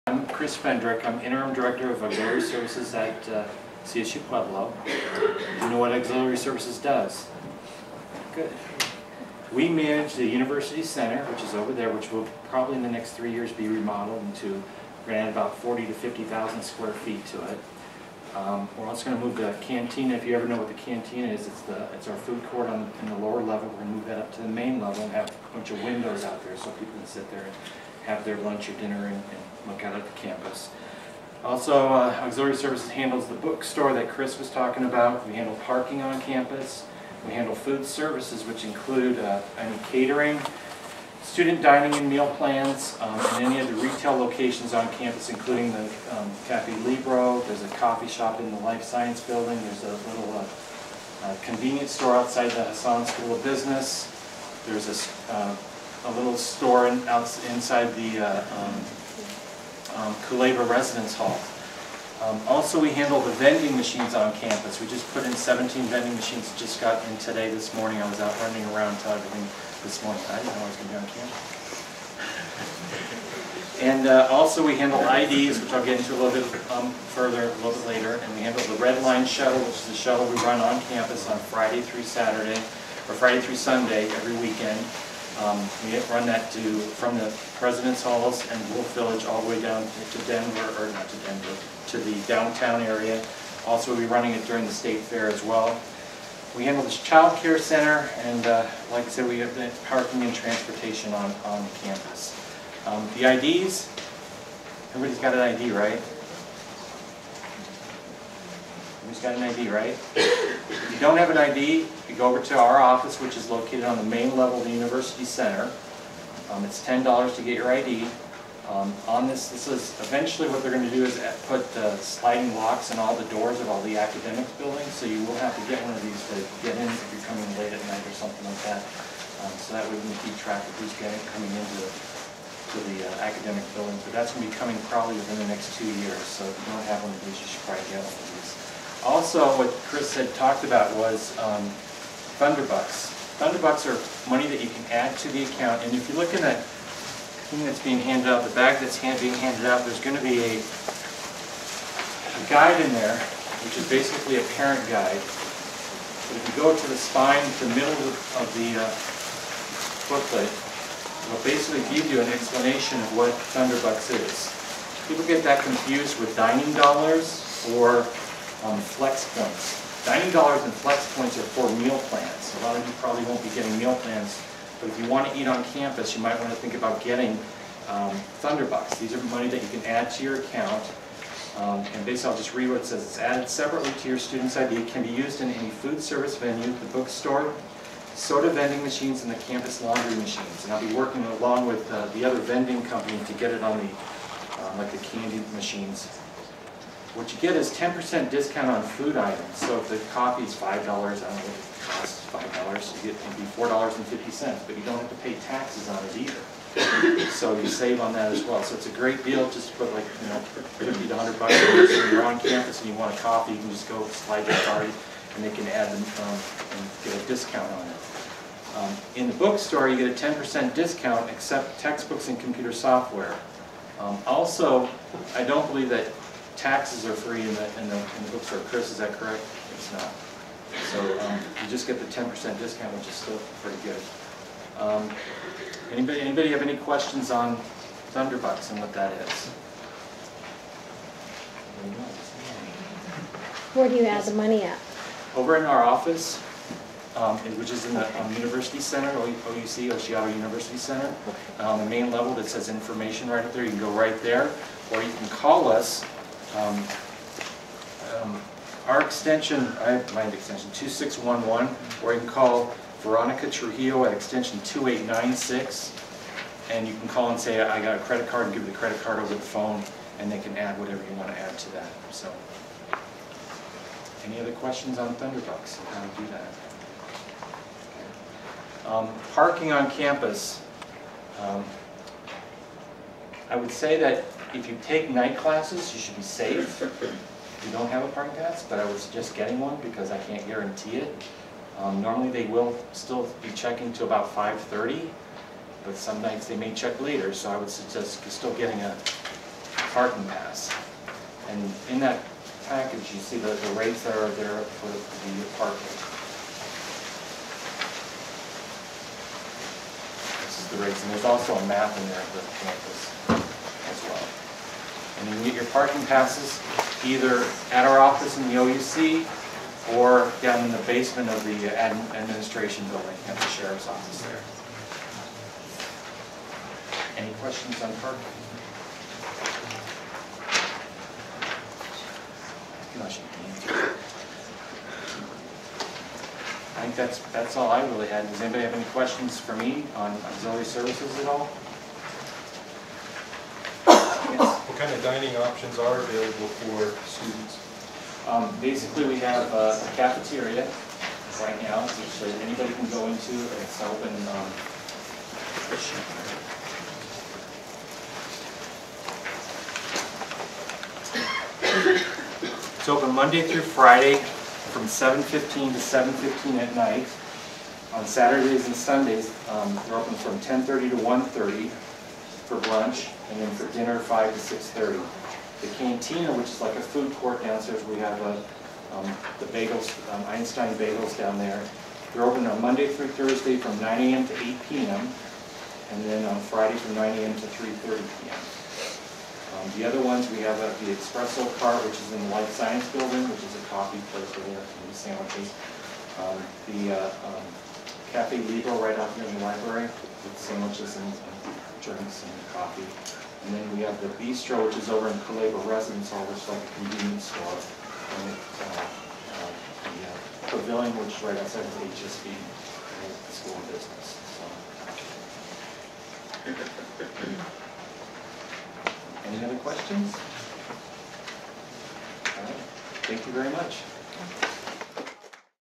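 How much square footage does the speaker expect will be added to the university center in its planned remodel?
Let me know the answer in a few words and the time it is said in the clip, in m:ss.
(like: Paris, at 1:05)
40,000 to 50,000 square feet, at 0:15.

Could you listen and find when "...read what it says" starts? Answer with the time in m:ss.
3:02.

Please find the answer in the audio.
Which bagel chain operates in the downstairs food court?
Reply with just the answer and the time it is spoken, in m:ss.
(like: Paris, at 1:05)
Einstein Bagels, at 6:20.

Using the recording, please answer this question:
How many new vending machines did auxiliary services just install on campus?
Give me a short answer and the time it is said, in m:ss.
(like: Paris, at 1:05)
17, at 1:05.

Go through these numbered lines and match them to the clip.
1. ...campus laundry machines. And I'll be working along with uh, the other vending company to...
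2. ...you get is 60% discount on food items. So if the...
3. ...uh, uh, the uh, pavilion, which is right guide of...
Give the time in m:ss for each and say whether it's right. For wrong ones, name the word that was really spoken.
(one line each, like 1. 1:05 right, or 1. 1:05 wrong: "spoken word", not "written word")
1. 3:09 right
2. 3:17 wrong: "10", not "60"
3. 6:48 wrong: "outside", not "guide".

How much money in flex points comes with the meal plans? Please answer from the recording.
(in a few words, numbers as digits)
$90.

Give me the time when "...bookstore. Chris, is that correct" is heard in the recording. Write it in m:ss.
3:48.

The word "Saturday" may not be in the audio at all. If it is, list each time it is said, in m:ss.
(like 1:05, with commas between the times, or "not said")
1:22, 6:08.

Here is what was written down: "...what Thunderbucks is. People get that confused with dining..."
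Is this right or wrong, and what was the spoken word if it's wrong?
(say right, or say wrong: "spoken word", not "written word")
right.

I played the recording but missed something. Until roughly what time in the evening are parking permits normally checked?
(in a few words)
5:30.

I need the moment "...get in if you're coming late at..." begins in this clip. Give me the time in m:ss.
2:06.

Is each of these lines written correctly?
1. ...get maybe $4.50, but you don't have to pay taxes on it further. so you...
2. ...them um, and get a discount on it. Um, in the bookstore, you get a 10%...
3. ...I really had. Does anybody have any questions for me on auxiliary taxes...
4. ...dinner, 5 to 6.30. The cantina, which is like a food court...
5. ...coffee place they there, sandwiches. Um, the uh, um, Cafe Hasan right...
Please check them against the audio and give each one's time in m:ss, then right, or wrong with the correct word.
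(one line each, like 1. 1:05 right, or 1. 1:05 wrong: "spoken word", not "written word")
1. 3:23 wrong: "either", not "further"
2. 3:35 right
3. 5:37 wrong: "services", not "taxes"
4. 6:13 right
5. 6:33 wrong: "Legal", not "Hasan".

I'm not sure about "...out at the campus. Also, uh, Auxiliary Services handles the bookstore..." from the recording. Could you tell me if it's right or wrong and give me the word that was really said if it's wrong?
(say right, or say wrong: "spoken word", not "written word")
right.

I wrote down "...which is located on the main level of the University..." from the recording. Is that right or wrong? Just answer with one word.
right.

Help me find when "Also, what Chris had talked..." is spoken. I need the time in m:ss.
2:19.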